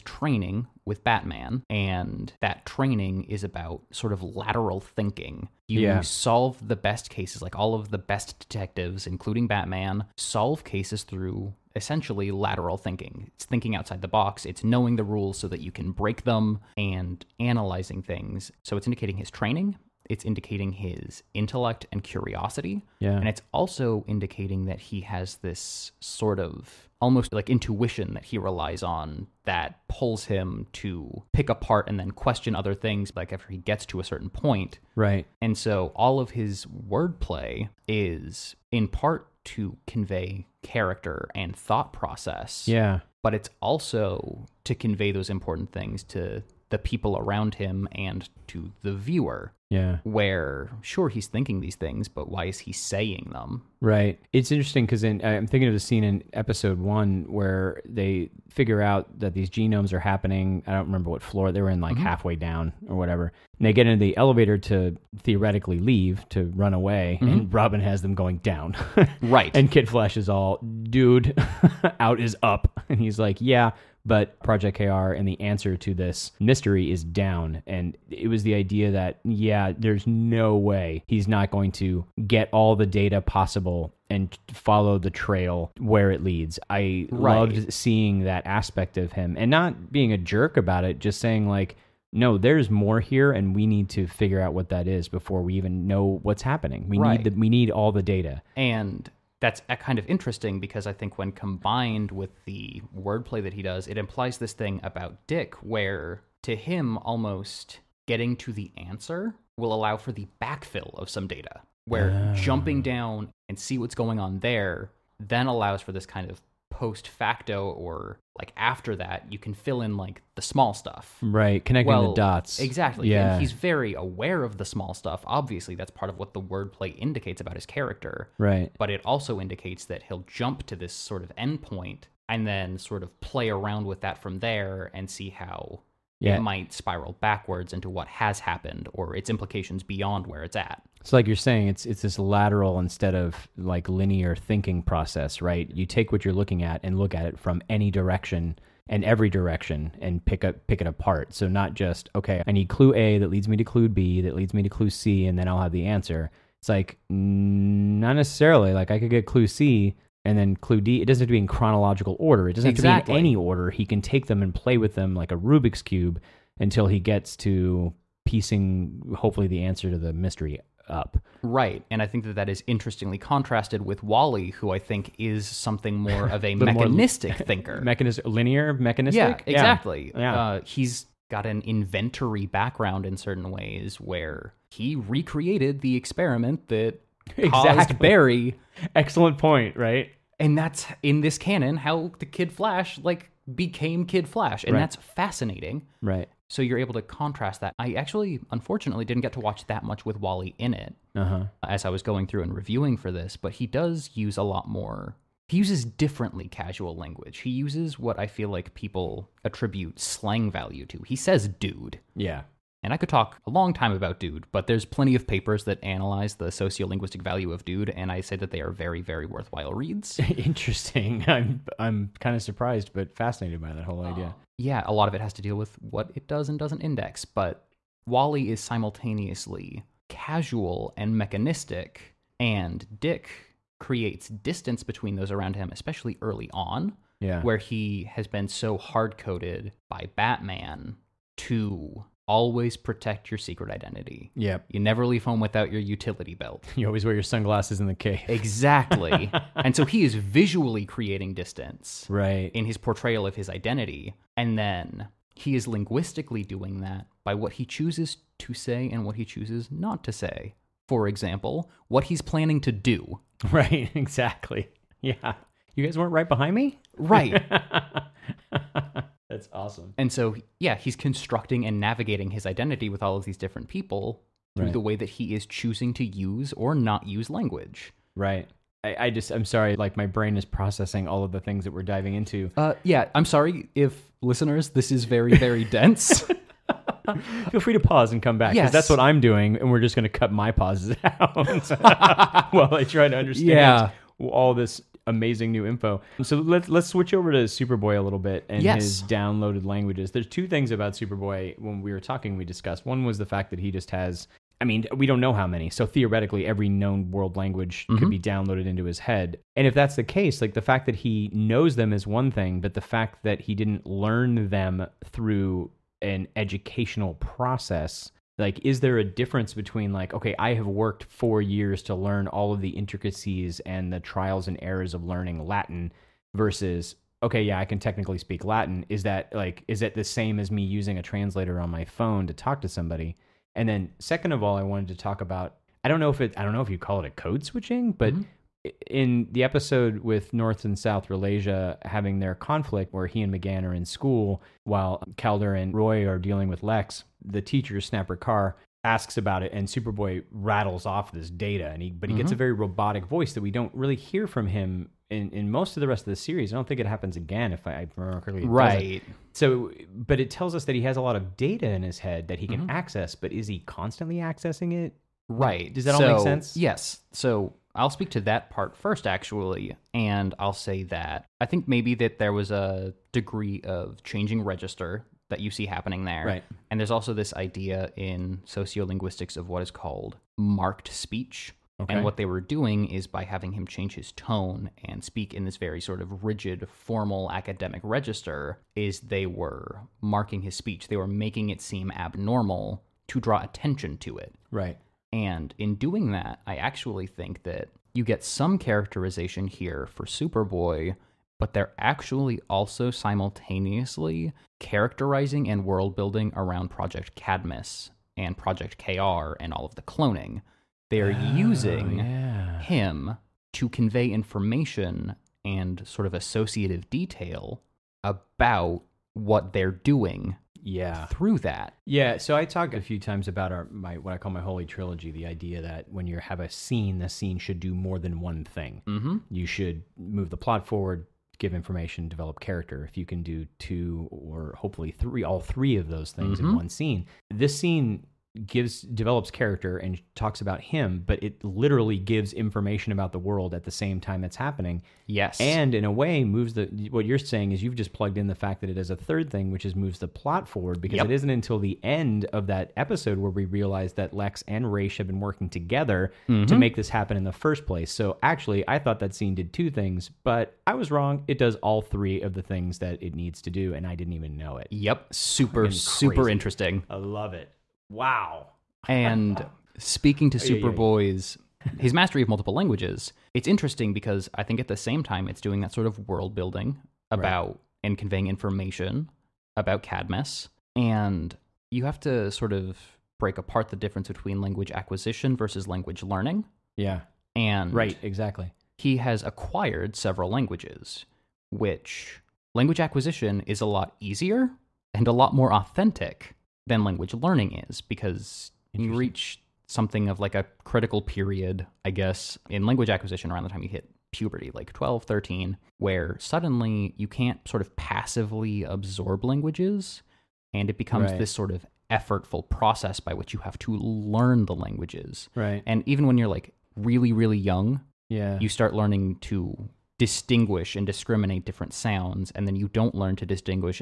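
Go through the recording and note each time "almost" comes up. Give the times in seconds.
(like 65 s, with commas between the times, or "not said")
27 s, 106 s.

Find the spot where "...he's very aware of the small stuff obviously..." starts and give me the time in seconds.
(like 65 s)
123 s.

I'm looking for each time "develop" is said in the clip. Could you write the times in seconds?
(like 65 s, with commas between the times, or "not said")
432 s, 438 s.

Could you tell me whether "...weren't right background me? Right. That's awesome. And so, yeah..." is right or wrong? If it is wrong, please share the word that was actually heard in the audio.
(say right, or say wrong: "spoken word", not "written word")
wrong: "behind", not "background".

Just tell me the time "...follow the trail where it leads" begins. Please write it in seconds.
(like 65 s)
84 s.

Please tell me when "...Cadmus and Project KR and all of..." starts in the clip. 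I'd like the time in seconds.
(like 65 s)
407 s.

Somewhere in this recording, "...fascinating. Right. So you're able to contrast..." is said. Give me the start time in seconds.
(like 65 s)
194 s.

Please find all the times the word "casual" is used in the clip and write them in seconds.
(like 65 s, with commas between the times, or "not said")
206 s, 230 s.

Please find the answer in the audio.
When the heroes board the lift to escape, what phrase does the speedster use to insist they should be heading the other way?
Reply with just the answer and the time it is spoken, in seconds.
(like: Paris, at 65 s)
Out is up, at 72 s.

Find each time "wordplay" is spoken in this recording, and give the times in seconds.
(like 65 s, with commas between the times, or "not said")
36 s, 102 s, 126 s.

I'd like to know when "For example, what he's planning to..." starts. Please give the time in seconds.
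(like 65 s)
260 s.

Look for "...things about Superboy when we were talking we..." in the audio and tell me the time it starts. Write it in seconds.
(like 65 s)
300 s.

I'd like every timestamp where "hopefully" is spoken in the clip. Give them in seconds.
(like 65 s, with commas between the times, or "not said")
169 s, 434 s.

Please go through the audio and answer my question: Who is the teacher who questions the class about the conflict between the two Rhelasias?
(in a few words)
Snapper Carr.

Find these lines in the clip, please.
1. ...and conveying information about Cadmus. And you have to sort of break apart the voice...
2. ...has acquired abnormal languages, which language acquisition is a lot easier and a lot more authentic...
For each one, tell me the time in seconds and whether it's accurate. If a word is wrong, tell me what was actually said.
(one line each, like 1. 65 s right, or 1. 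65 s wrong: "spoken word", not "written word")
1. 477 s wrong: "difference", not "voice"
2. 488 s wrong: "several", not "abnormal".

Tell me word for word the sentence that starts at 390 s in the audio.
They were making it seem abnormal to draw attention to it.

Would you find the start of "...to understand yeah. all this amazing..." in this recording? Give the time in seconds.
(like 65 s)
293 s.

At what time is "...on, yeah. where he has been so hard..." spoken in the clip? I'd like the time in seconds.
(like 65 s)
236 s.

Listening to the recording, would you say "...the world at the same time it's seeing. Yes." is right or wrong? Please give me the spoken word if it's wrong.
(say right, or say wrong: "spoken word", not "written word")
wrong: "happening", not "seeing".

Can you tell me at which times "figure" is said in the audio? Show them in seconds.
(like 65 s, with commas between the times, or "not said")
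58 s, 94 s.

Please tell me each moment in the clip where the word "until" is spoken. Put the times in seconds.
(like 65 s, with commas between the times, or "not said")
166 s, 451 s.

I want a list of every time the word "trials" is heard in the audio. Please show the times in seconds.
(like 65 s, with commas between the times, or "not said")
324 s.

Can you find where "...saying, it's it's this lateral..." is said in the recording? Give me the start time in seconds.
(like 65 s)
141 s.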